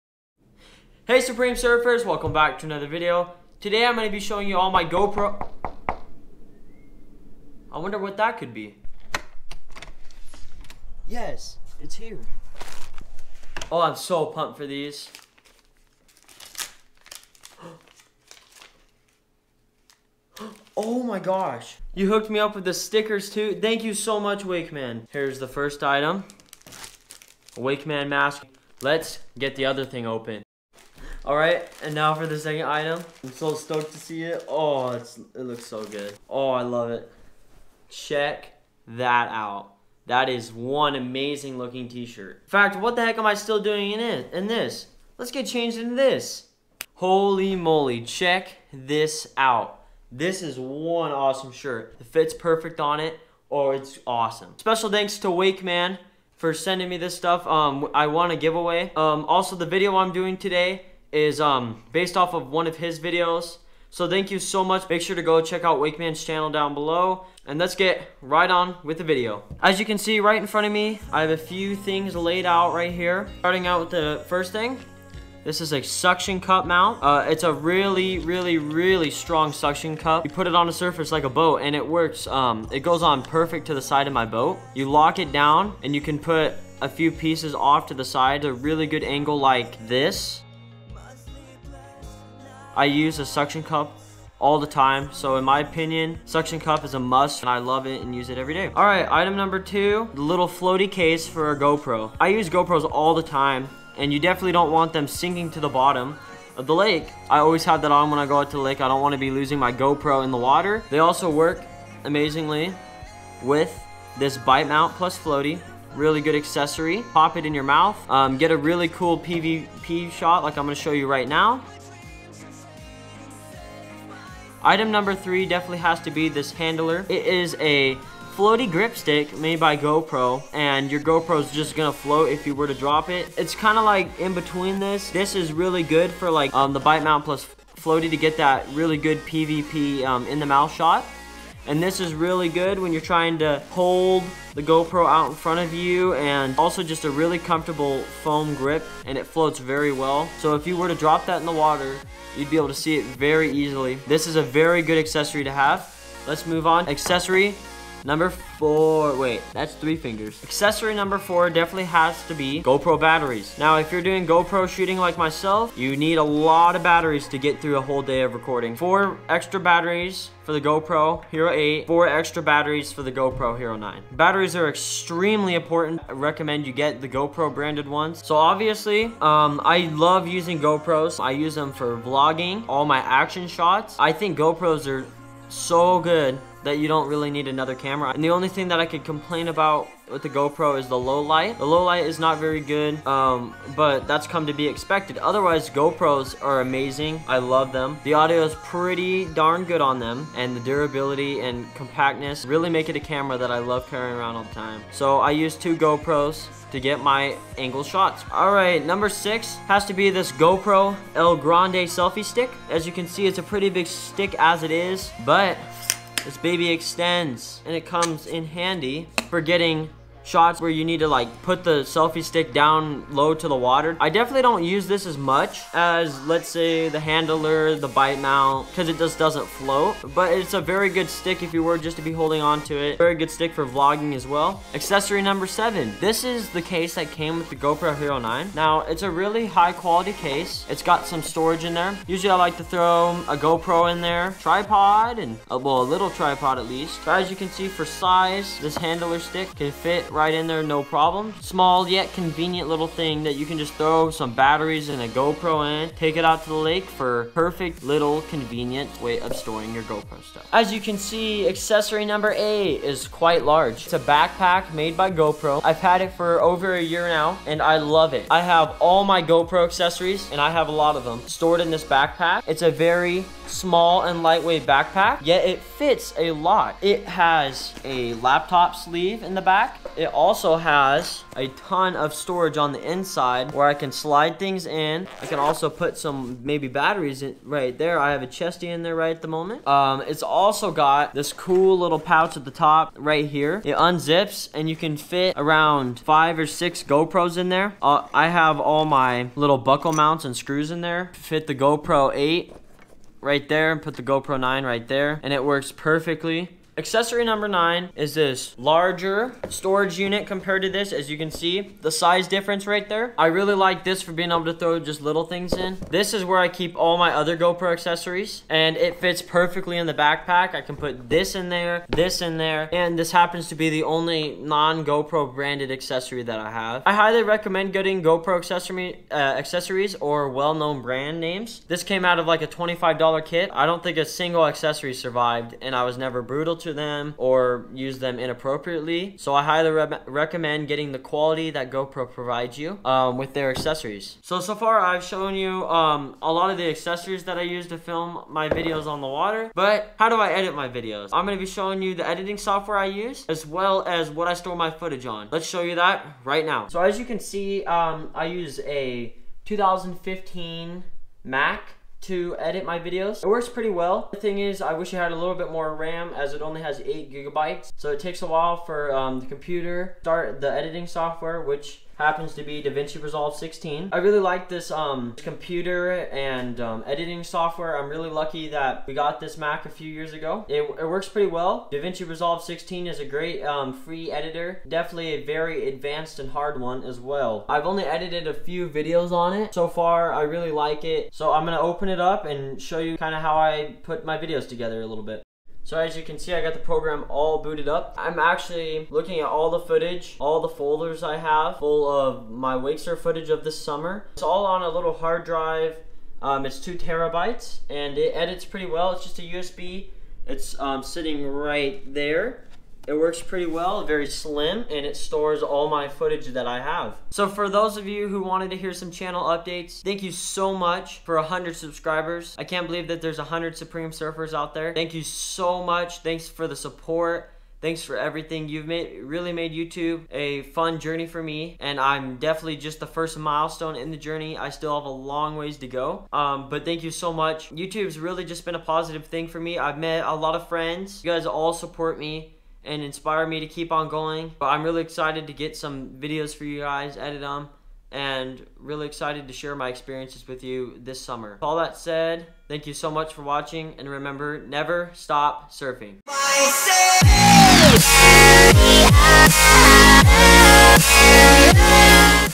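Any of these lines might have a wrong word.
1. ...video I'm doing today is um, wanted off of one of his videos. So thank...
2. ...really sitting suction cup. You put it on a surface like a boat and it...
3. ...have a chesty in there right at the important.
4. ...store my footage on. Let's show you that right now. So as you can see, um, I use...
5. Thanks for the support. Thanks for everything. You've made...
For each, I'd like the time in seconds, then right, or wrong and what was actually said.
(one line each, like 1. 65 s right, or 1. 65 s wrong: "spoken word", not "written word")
1. 59 s wrong: "based", not "wanted"
2. 78 s wrong: "strong", not "sitting"
3. 288 s wrong: "moment", not "important"
4. 354 s right
5. 425 s right.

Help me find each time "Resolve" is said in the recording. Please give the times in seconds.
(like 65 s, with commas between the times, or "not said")
373 s, 382 s.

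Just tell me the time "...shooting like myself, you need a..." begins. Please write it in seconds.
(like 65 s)
164 s.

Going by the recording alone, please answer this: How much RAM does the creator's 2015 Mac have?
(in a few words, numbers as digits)
8 gigabytes.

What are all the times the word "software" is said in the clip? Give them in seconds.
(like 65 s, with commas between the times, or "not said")
352 s, 370 s, 377 s.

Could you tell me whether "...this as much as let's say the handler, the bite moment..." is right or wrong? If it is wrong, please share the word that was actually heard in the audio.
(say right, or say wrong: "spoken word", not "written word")
wrong: "mount", not "moment".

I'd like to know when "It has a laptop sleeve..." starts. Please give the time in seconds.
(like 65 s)
276 s.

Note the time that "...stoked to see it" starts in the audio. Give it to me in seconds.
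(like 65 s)
33 s.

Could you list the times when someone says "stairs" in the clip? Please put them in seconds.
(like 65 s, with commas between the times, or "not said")
not said.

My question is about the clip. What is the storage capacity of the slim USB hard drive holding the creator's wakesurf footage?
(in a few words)
2 terabytes.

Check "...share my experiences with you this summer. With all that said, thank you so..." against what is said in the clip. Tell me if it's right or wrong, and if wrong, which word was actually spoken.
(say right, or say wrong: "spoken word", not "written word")
right.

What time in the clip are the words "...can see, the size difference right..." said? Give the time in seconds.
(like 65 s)
311 s.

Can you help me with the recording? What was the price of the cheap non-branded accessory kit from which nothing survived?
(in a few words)
$25.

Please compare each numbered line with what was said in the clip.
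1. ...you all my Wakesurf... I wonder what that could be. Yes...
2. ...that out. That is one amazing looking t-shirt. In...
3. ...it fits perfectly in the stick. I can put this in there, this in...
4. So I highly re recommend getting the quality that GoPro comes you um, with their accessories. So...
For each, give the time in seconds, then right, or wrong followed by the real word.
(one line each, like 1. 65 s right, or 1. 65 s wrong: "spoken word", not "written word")
1. 4 s wrong: "GoPro", not "Wakesurf"
2. 38 s right
3. 318 s wrong: "backpack", not "stick"
4. 339 s wrong: "provides", not "comes".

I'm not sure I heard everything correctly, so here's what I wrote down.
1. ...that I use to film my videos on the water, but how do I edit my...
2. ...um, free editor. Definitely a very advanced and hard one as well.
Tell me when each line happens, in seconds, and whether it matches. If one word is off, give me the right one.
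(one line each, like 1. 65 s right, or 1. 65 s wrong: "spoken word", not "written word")
1. 347 s right
2. 383 s right.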